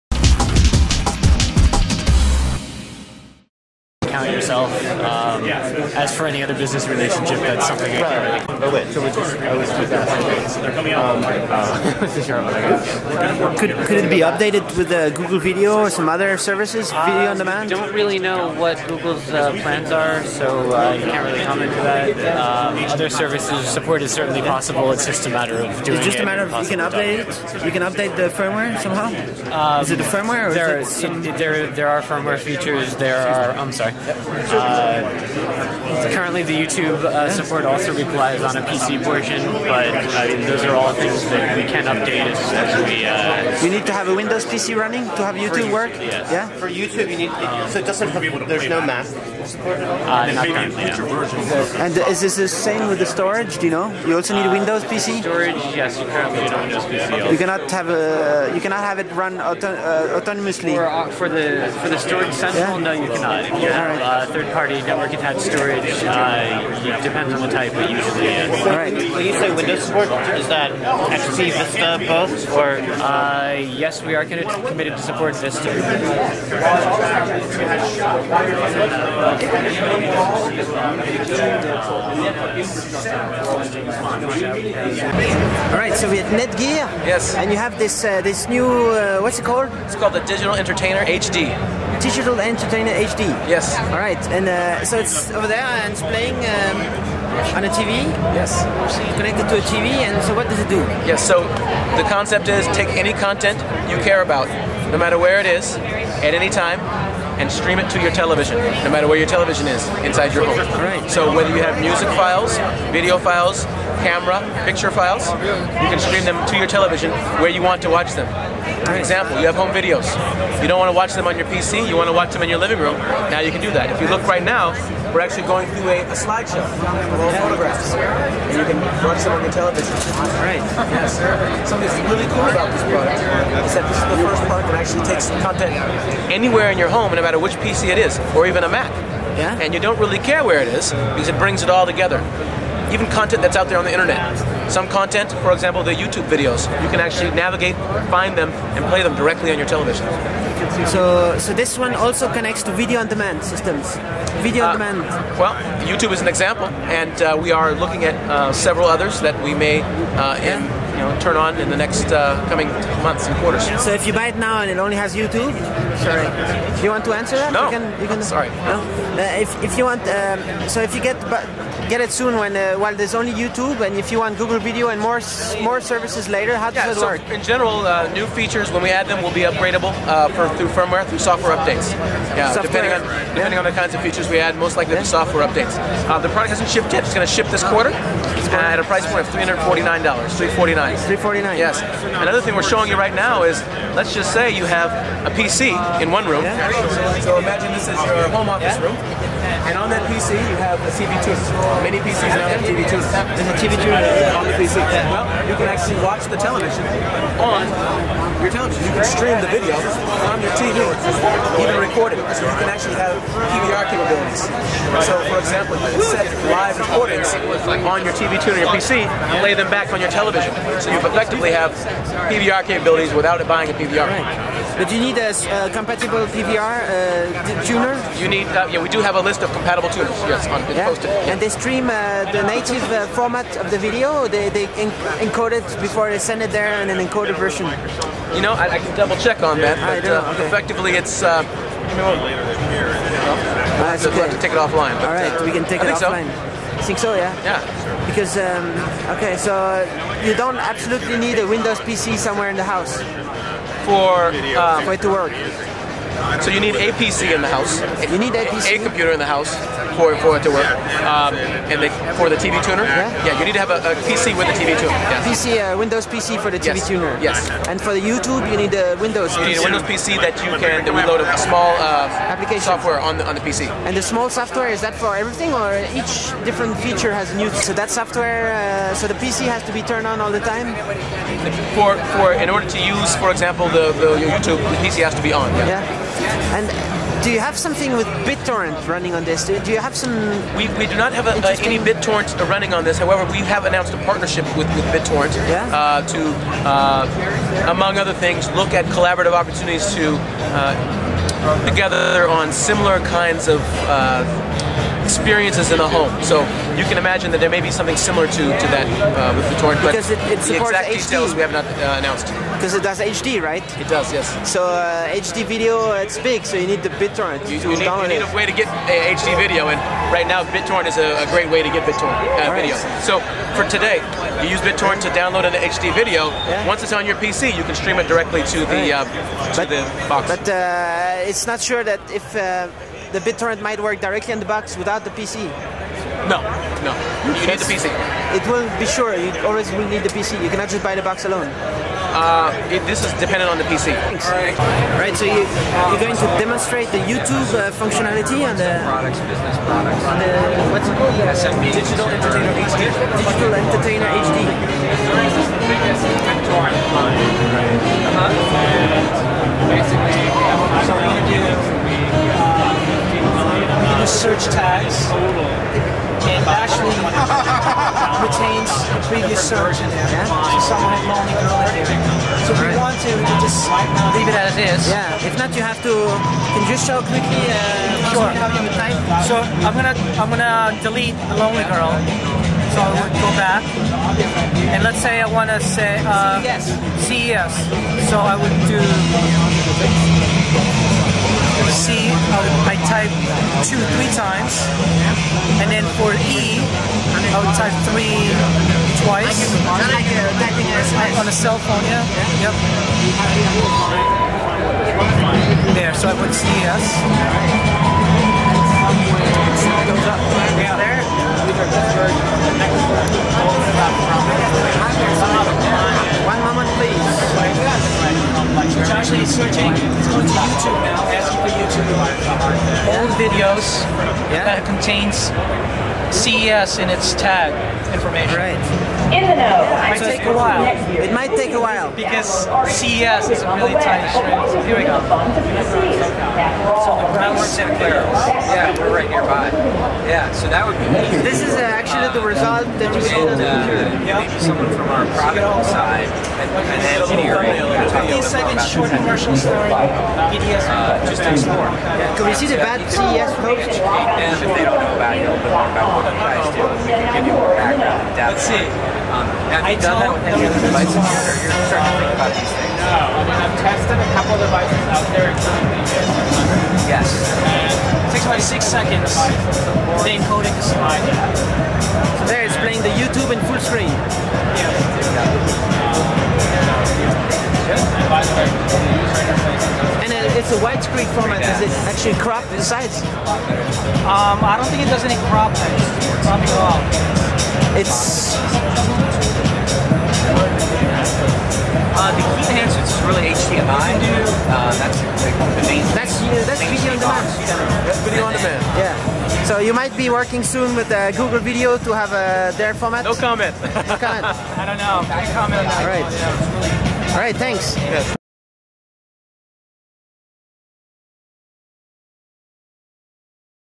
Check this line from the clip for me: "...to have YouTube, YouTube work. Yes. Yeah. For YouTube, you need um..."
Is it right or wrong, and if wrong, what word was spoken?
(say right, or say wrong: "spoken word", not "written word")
right.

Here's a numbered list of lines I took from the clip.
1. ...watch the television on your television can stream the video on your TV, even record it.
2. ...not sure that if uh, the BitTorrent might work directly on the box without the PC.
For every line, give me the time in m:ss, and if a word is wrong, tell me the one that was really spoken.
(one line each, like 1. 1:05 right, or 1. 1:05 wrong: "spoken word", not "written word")
1. 3:26 right
2. 5:31 right.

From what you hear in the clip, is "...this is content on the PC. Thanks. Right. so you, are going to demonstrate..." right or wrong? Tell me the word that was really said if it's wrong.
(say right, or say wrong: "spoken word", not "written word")
wrong: "dependent", not "content".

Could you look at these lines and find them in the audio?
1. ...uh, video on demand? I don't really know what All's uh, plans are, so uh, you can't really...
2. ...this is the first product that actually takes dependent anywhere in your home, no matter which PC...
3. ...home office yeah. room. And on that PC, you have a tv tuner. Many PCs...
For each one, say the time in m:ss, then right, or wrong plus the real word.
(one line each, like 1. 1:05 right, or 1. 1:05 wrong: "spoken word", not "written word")
1. 0:16 wrong: "Google", not "All"
2. 2:13 wrong: "content", not "dependent"
3. 3:18 right.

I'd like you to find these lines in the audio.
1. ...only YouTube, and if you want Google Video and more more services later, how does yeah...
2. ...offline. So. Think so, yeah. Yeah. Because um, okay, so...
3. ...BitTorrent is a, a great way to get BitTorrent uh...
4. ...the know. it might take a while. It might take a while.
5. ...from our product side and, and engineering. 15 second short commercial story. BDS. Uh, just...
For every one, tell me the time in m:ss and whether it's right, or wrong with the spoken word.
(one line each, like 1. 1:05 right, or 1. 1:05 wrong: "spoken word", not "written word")
1. 2:53 right
2. 4:05 right
3. 5:20 right
4. 7:09 right
5. 7:24 right.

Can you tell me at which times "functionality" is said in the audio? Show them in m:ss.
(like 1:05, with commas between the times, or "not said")
5:47.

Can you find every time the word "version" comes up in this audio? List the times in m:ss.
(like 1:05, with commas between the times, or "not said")
3:57.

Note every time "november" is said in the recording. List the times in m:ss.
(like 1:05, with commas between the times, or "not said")
not said.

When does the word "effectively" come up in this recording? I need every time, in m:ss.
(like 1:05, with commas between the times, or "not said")
3:40, 4:00.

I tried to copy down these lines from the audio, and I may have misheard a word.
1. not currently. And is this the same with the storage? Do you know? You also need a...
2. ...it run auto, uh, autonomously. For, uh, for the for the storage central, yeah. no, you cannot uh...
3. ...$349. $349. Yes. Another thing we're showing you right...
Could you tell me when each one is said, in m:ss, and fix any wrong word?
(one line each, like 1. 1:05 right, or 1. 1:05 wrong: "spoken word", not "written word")
1. 0:50 right
2. 0:58 right
3. 3:09 right.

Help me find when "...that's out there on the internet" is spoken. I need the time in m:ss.
2:23.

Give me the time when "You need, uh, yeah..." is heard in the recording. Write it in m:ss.
3:48.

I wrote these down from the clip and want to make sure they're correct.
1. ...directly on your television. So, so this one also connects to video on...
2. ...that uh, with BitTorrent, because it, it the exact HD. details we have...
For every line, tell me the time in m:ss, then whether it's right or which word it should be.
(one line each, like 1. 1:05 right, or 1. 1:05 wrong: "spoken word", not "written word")
1. 2:29 right
2. 5:08 right.